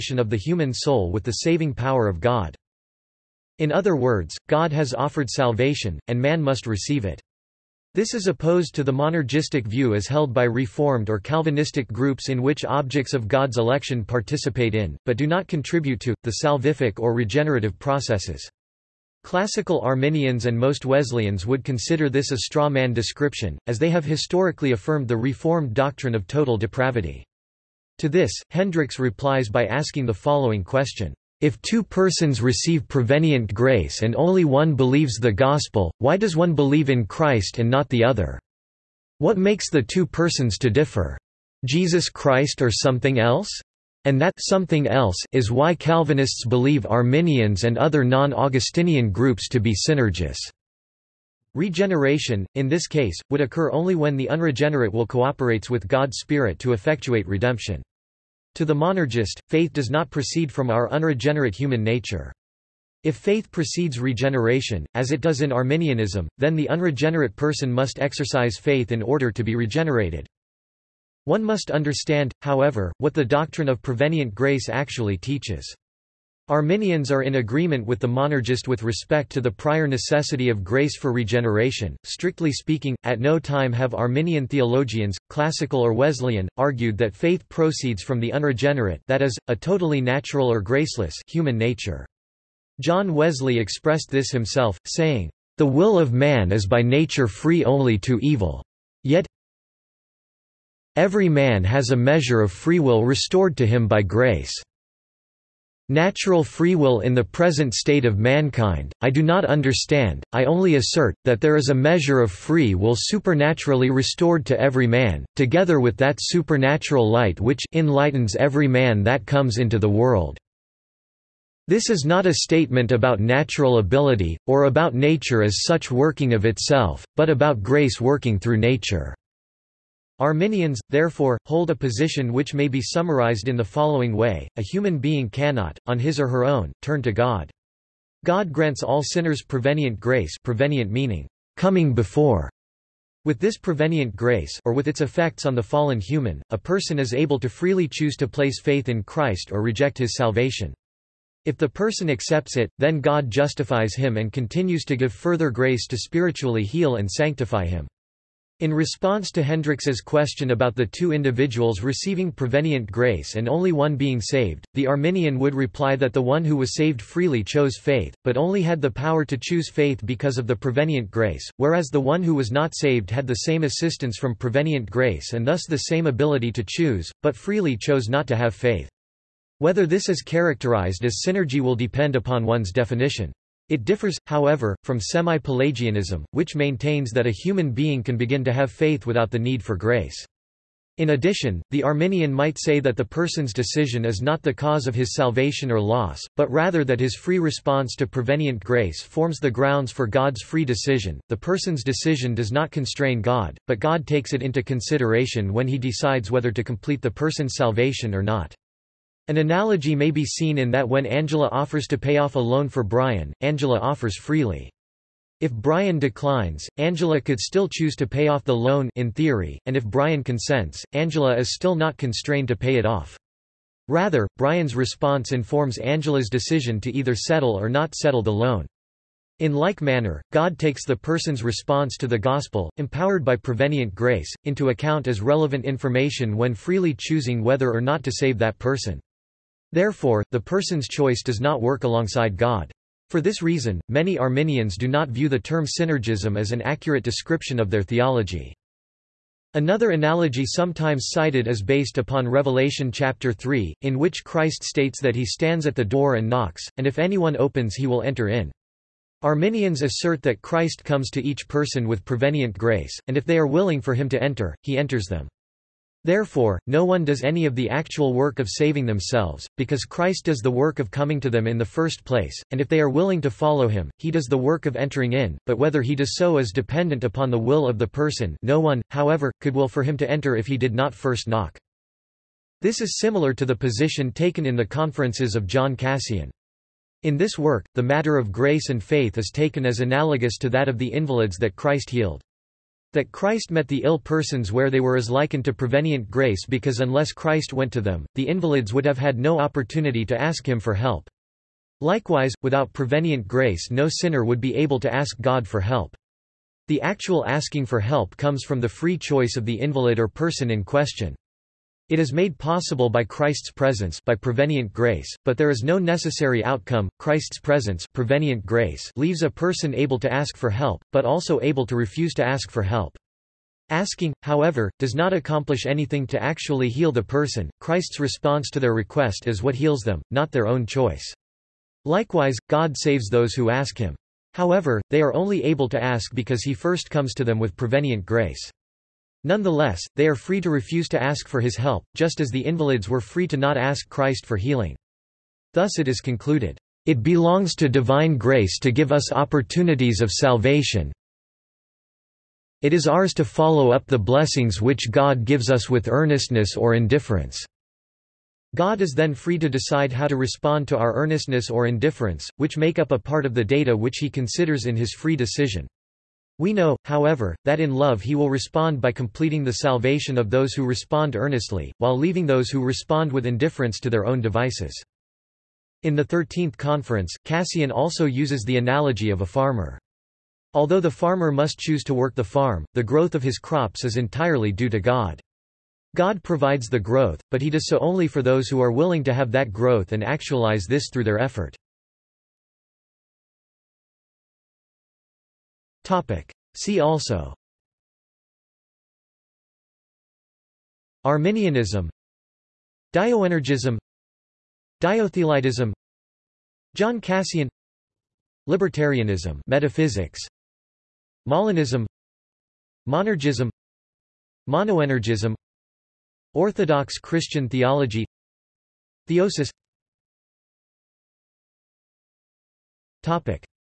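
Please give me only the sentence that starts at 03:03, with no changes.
It differs, however, from semi-Pelagianism, which maintains that a human being can begin to have faith without the need for grace.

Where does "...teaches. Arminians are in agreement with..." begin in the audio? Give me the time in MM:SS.
01:15.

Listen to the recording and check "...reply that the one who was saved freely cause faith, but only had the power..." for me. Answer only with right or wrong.
wrong.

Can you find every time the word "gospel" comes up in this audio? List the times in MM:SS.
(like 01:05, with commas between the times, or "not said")
00:35, 03:52.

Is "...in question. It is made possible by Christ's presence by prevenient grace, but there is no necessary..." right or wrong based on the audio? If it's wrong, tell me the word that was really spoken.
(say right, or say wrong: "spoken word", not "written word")
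right.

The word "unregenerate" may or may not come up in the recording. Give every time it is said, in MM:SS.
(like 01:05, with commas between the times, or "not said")
00:54, 01:00, 01:06, 01:28.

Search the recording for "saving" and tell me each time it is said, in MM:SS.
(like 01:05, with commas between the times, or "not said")
00:01, 04:28.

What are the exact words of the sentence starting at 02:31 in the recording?
If the person accepts it, then God justifies him and continues to give further grace to spiritually heal and sanctify him.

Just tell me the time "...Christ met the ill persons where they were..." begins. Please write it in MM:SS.
04:53.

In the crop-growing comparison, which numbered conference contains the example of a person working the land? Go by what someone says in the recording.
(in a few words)
Thirteenth Conference.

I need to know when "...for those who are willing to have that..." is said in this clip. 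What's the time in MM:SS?
06:28.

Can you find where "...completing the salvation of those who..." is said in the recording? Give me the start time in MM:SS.
06:08.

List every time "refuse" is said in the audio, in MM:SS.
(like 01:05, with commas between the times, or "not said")
05:21, 05:40.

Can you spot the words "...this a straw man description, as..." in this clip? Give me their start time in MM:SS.
00:22.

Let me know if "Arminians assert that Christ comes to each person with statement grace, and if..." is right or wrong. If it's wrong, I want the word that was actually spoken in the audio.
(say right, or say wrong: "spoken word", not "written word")
wrong: "prevenient", not "statement".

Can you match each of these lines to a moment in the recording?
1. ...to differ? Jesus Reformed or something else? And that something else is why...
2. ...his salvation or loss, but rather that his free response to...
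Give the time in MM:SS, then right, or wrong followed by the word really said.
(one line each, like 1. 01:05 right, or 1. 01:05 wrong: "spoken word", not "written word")
1. 00:40 wrong: "Christ", not "Reformed"
2. 03:14 right.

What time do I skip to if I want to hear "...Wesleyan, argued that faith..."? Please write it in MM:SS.
01:25.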